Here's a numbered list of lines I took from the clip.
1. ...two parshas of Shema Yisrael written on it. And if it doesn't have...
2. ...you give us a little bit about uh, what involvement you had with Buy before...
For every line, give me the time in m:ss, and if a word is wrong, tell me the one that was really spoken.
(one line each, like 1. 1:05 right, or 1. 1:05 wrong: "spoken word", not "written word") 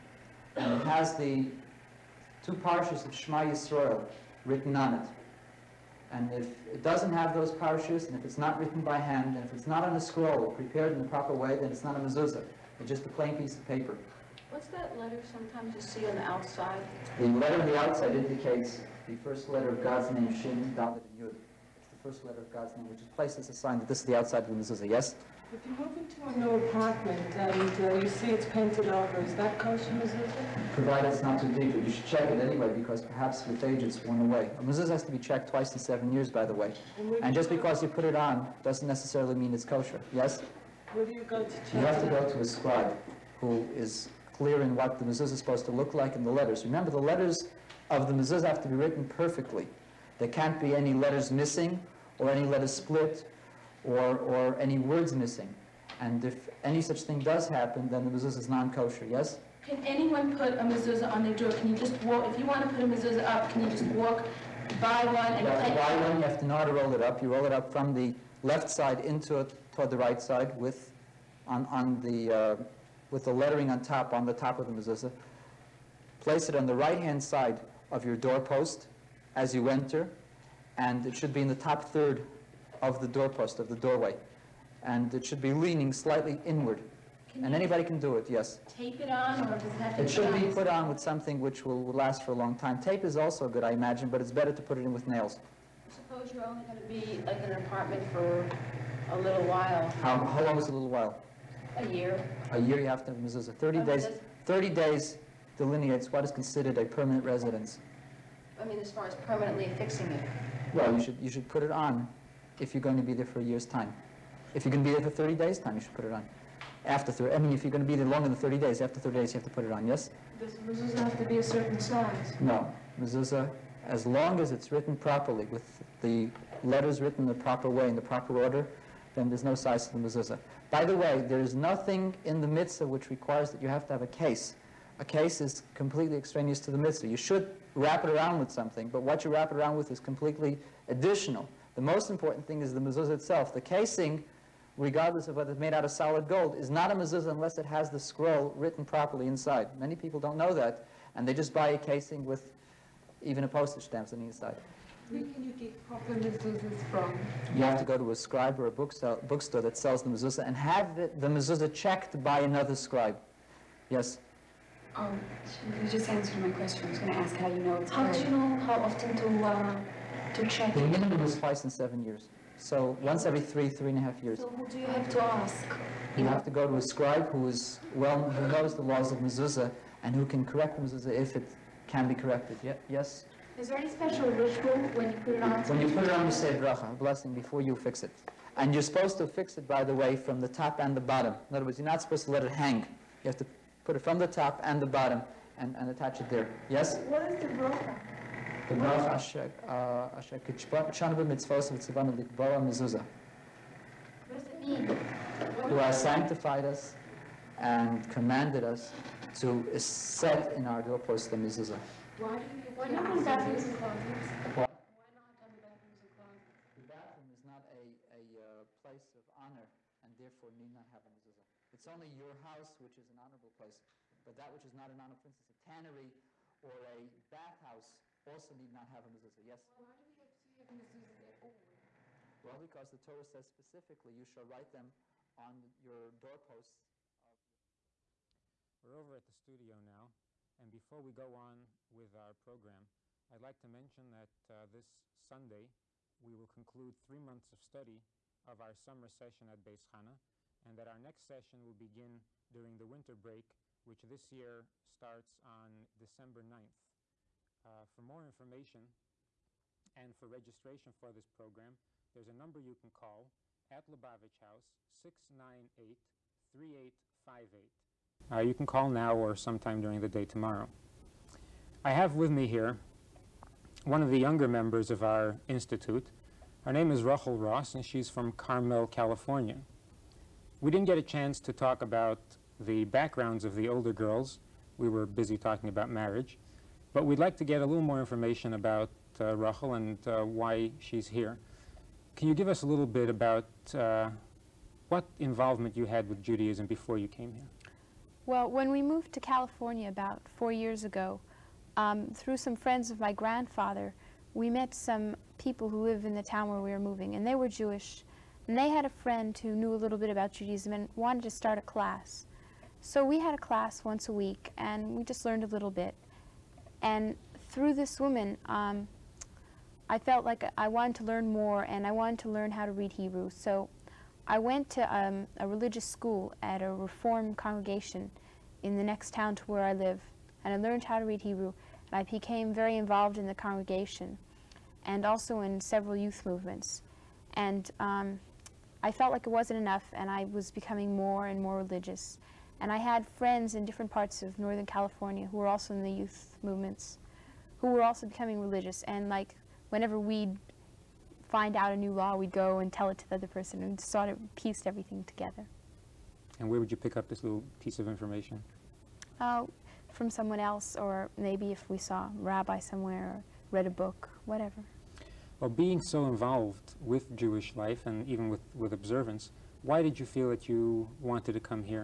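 1. 0:02 right
2. 4:52 wrong: "Judaism", not "Buy".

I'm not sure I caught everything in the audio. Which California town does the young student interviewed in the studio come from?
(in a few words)
Carmel.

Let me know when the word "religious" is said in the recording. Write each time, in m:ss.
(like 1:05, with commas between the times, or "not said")
5:25, 5:41, 5:48.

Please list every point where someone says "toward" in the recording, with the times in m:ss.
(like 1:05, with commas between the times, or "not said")
1:09.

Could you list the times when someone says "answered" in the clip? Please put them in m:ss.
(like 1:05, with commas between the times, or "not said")
2:46.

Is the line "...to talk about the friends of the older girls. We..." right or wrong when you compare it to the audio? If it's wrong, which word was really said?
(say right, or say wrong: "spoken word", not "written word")
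wrong: "backgrounds", not "friends".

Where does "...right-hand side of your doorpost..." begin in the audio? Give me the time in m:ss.
1:16.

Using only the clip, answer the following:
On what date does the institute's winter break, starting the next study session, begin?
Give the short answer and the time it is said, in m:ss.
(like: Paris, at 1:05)
December 9, at 4:15.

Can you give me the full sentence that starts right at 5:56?
And where would you pick up this little piece of information?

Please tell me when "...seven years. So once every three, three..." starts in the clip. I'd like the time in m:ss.
2:51.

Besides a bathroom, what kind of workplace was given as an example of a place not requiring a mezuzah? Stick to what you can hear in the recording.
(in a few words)
tannery.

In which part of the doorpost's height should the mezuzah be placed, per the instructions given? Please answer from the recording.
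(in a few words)
top third.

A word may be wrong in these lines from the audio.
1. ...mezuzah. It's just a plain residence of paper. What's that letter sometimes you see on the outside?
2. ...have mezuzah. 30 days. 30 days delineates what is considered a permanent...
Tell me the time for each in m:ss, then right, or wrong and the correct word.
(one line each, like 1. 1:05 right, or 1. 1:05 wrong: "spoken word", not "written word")
1. 0:11 wrong: "piece", not "residence"
2. 1:43 right.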